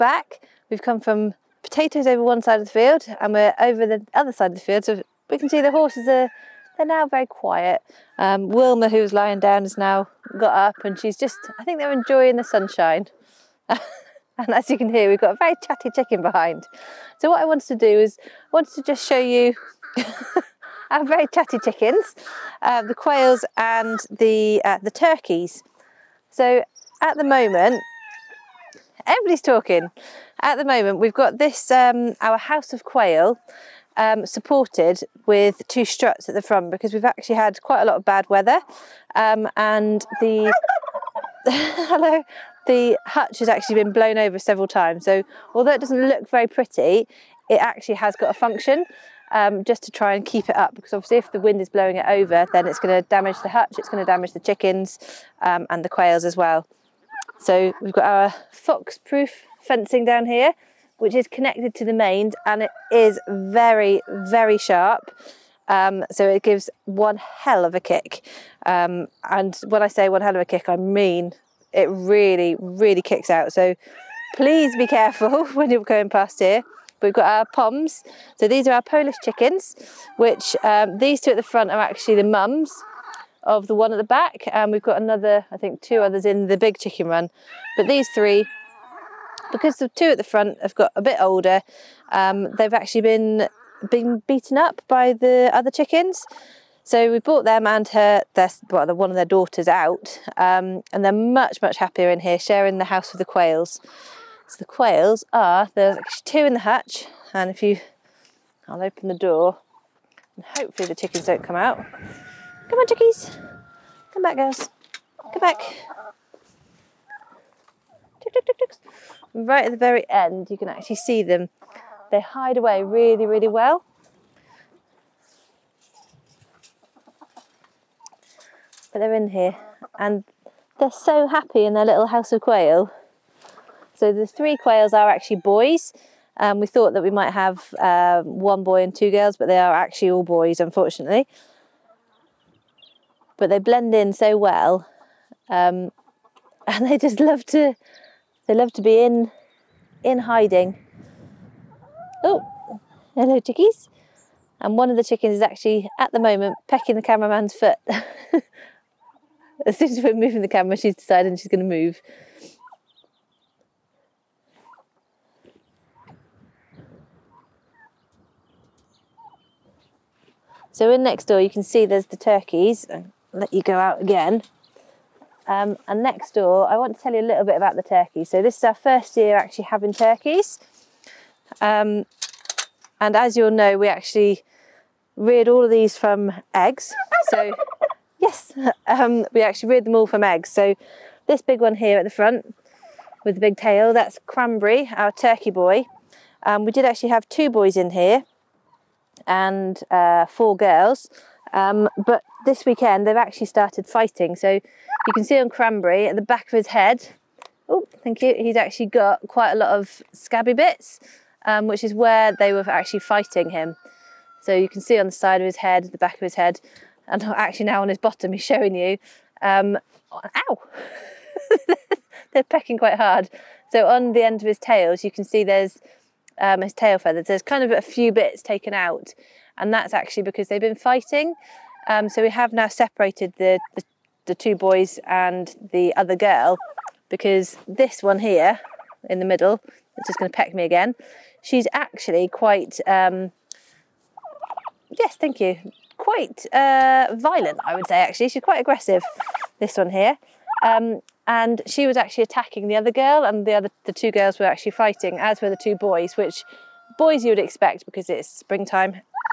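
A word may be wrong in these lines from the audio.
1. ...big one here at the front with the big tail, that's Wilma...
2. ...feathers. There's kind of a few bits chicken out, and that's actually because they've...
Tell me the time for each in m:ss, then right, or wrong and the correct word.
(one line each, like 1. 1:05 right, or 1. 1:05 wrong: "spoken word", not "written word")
1. 3:11 wrong: "Cranberry", not "Wilma"
2. 3:46 wrong: "taken", not "chicken".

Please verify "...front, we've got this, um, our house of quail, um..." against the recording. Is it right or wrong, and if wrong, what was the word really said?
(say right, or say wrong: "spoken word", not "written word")
wrong: "moment", not "front".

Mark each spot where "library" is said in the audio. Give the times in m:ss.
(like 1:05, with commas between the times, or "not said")
not said.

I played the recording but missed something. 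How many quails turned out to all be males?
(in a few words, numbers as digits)
3.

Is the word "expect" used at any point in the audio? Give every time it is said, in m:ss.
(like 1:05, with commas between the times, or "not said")
4:17.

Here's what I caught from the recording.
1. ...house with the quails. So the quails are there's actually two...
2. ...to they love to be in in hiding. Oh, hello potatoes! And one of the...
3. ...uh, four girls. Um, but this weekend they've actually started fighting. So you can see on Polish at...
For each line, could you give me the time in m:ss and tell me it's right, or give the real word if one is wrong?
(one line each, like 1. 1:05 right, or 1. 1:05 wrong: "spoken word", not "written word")
1. 1:42 right
2. 2:27 wrong: "chickies", not "potatoes"
3. 3:19 wrong: "Cranberry", not "Polish".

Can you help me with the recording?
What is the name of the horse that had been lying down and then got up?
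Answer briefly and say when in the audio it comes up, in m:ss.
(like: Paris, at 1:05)
Wilma, at 0:08.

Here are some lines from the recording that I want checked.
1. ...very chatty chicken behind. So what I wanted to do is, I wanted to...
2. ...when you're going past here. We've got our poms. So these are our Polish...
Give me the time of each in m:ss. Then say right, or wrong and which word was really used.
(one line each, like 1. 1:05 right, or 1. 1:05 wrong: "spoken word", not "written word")
1. 0:15 right
2. 1:15 right.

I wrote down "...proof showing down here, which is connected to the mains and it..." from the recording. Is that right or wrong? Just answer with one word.
wrong.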